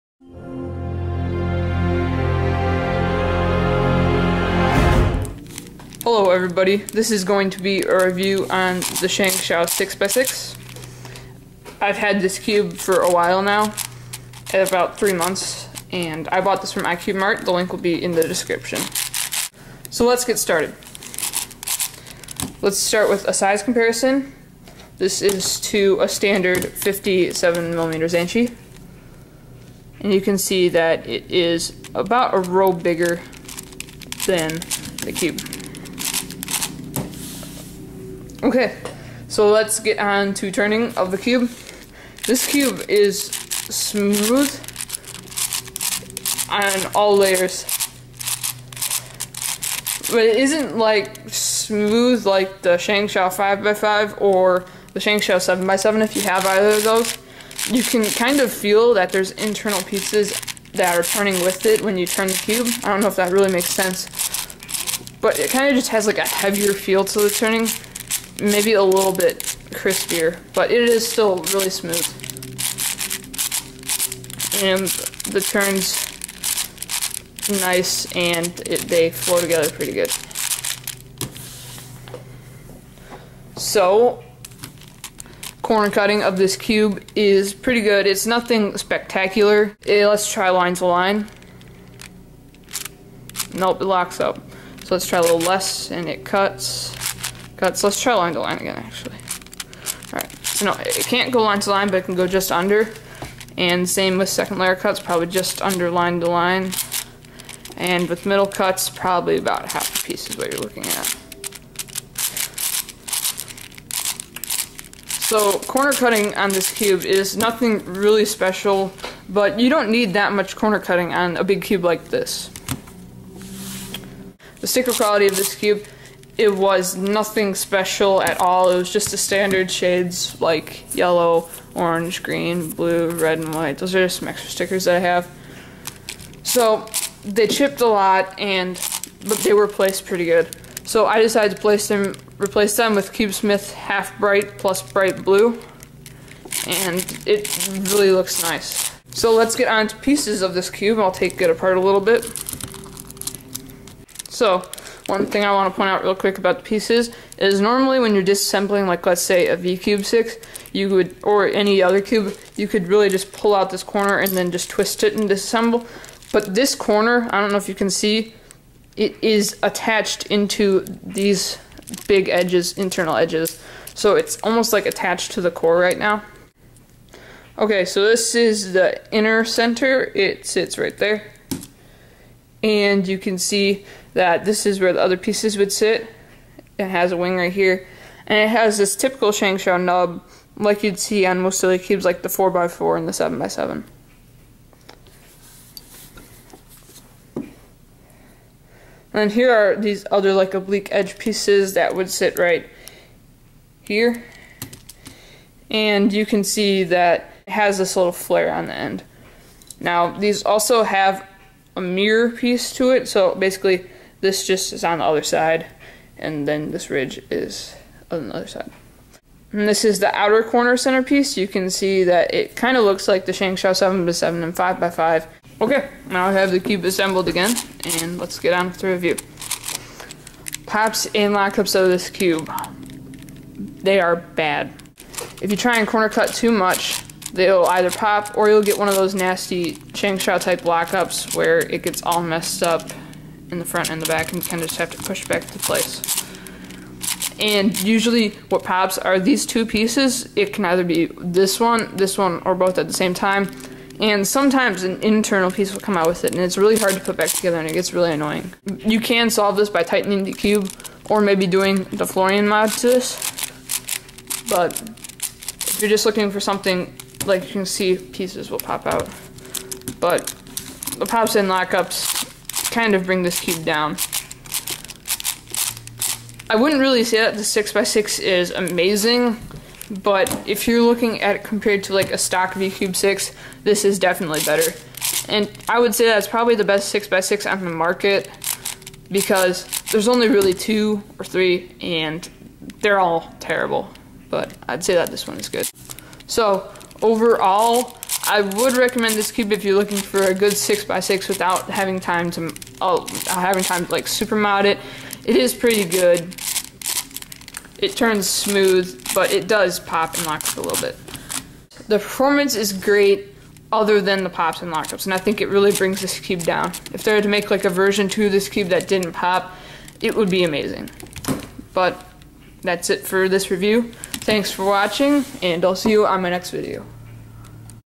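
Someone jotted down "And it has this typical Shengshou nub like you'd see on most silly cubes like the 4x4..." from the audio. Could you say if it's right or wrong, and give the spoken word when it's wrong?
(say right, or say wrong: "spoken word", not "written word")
right.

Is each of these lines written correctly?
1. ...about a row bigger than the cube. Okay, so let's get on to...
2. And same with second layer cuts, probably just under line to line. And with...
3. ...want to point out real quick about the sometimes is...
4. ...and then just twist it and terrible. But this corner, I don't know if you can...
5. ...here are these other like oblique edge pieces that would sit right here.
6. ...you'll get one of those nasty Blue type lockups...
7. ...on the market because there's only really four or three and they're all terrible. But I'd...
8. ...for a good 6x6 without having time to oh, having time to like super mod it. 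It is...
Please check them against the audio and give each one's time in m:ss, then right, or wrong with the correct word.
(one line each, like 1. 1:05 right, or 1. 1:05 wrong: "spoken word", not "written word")
1. 0:31 right
2. 1:43 right
3. 2:35 wrong: "pieces", not "sometimes"
4. 2:44 wrong: "disassemble", not "terrible"
5. 3:19 right
6. 3:58 wrong: "Shengshou", not "Blue"
7. 4:47 wrong: "two", not "four"
8. 4:59 right.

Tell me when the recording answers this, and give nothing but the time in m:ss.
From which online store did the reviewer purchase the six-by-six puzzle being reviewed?
0:16.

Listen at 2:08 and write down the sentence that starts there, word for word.
It was just the standard shades like yellow, orange, green, blue, red, and white.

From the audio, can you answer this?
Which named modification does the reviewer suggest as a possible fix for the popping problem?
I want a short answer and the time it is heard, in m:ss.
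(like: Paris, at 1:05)
Florian mod, at 4:22.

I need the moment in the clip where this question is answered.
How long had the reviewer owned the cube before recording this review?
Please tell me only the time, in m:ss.
0:14.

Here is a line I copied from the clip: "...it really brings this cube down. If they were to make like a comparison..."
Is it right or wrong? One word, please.
wrong.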